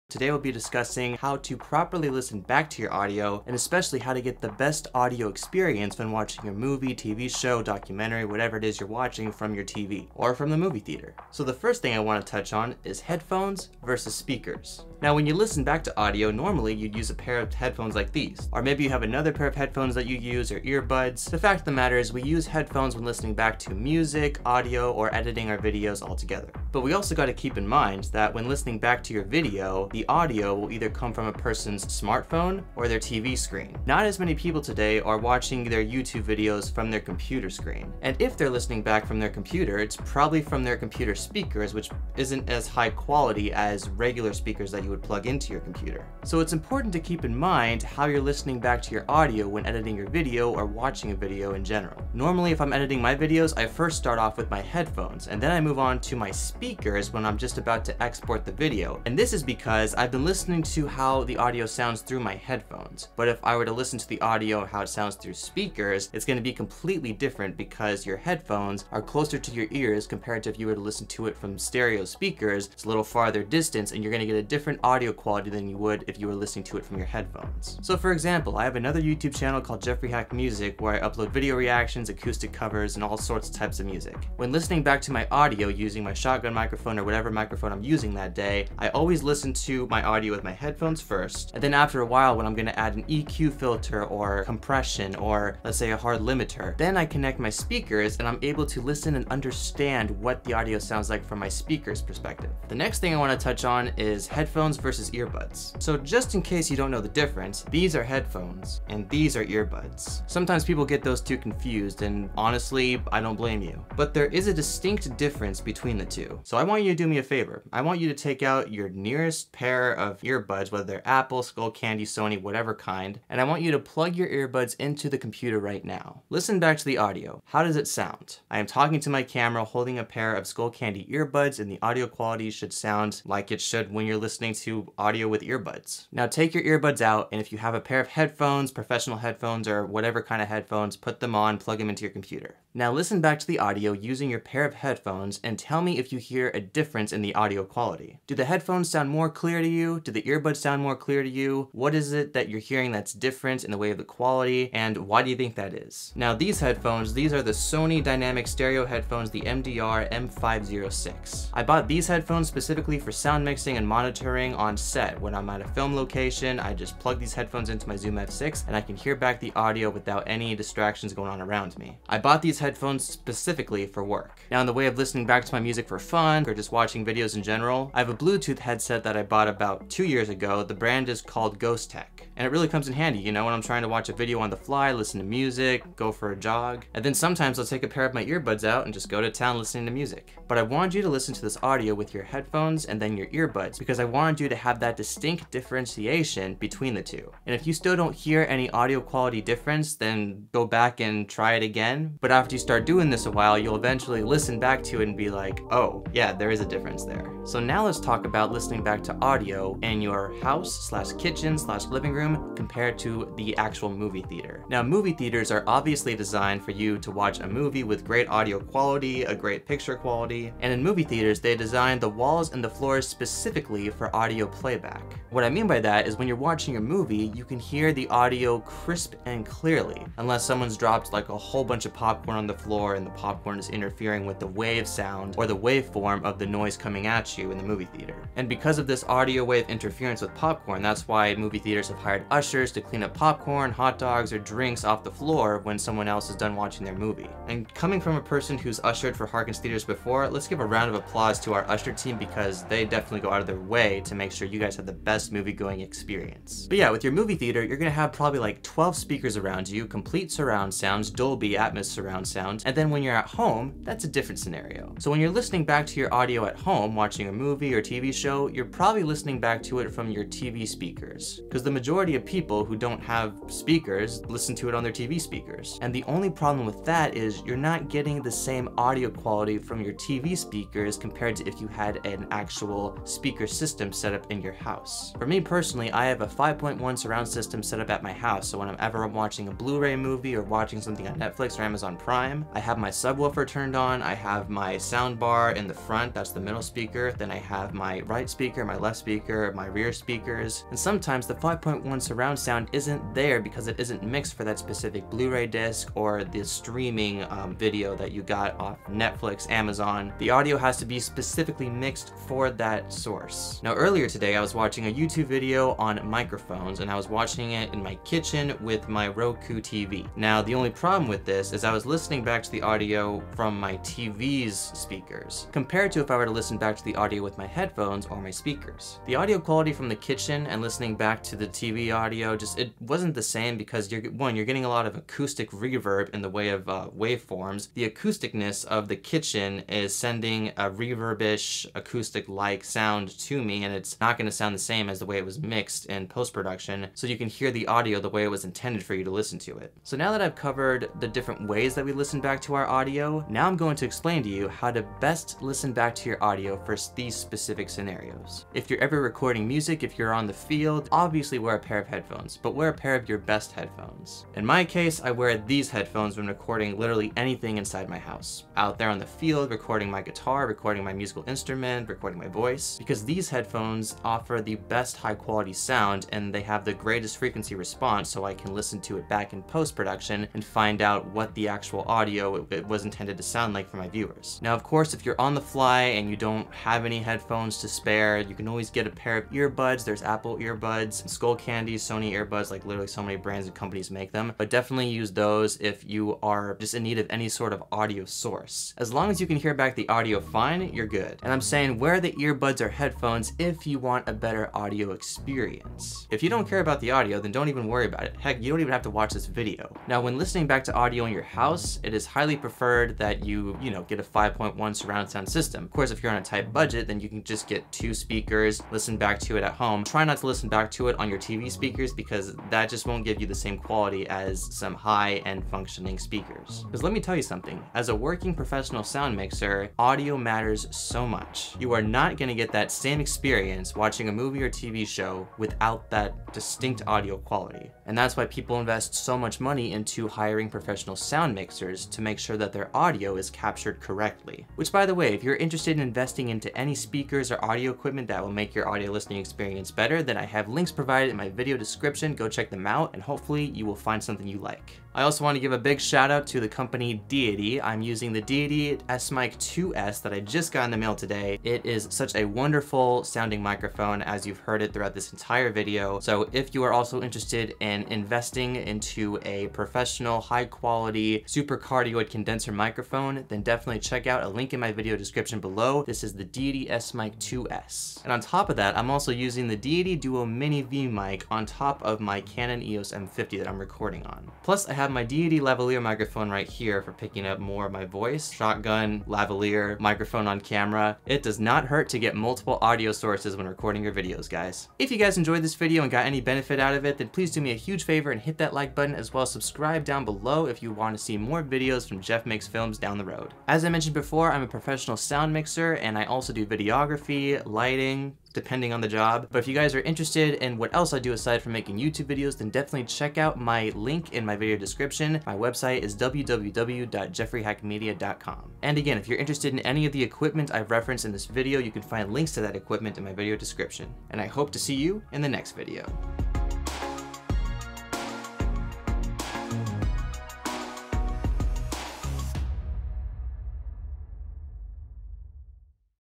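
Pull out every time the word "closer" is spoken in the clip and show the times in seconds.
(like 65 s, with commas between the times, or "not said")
69 s.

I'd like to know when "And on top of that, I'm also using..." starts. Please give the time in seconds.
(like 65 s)
478 s.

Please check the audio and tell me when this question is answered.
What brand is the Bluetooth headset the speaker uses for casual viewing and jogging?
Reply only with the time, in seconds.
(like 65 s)
181 s.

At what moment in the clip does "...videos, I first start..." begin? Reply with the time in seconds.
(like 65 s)
53 s.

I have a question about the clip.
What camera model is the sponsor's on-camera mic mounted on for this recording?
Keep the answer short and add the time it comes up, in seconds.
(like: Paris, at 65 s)
Canon EOS M50, at 482 s.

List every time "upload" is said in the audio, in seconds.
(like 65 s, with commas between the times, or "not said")
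81 s.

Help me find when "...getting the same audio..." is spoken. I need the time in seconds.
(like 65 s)
277 s.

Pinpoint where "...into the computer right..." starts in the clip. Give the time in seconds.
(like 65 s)
124 s.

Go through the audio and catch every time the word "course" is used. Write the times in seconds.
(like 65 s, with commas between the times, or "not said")
384 s, 415 s.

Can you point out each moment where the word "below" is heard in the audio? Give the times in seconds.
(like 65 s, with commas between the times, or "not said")
475 s, 500 s.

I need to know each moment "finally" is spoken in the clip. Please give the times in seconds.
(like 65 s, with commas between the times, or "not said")
not said.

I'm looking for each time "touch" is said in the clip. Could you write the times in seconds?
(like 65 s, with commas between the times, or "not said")
12 s, 103 s.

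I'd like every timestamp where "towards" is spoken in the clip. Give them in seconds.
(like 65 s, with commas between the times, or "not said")
not said.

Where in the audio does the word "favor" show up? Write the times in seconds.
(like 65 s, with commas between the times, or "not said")
117 s, 497 s.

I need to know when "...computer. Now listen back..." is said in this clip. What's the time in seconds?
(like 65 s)
142 s.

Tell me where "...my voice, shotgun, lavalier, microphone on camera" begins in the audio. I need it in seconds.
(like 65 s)
487 s.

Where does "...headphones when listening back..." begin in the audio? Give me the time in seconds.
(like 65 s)
22 s.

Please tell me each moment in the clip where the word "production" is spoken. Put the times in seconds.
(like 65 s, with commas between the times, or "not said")
346 s, 379 s.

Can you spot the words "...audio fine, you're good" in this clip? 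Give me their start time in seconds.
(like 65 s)
399 s.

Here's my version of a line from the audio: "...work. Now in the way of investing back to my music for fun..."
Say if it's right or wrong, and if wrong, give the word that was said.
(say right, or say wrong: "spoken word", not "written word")
wrong: "listening", not "investing".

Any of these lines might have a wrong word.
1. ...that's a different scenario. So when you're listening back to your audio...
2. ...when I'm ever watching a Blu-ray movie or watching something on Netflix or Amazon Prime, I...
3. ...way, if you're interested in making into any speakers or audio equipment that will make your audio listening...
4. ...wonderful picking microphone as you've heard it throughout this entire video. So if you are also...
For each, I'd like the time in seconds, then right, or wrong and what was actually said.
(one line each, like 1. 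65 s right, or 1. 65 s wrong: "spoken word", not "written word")
1. 263 s right
2. 288 s right
3. 444 s wrong: "investing", not "making"
4. 462 s wrong: "sounding", not "picking".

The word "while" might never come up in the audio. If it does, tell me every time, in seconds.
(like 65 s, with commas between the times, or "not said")
92 s, 203 s.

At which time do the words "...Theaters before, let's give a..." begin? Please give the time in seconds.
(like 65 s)
249 s.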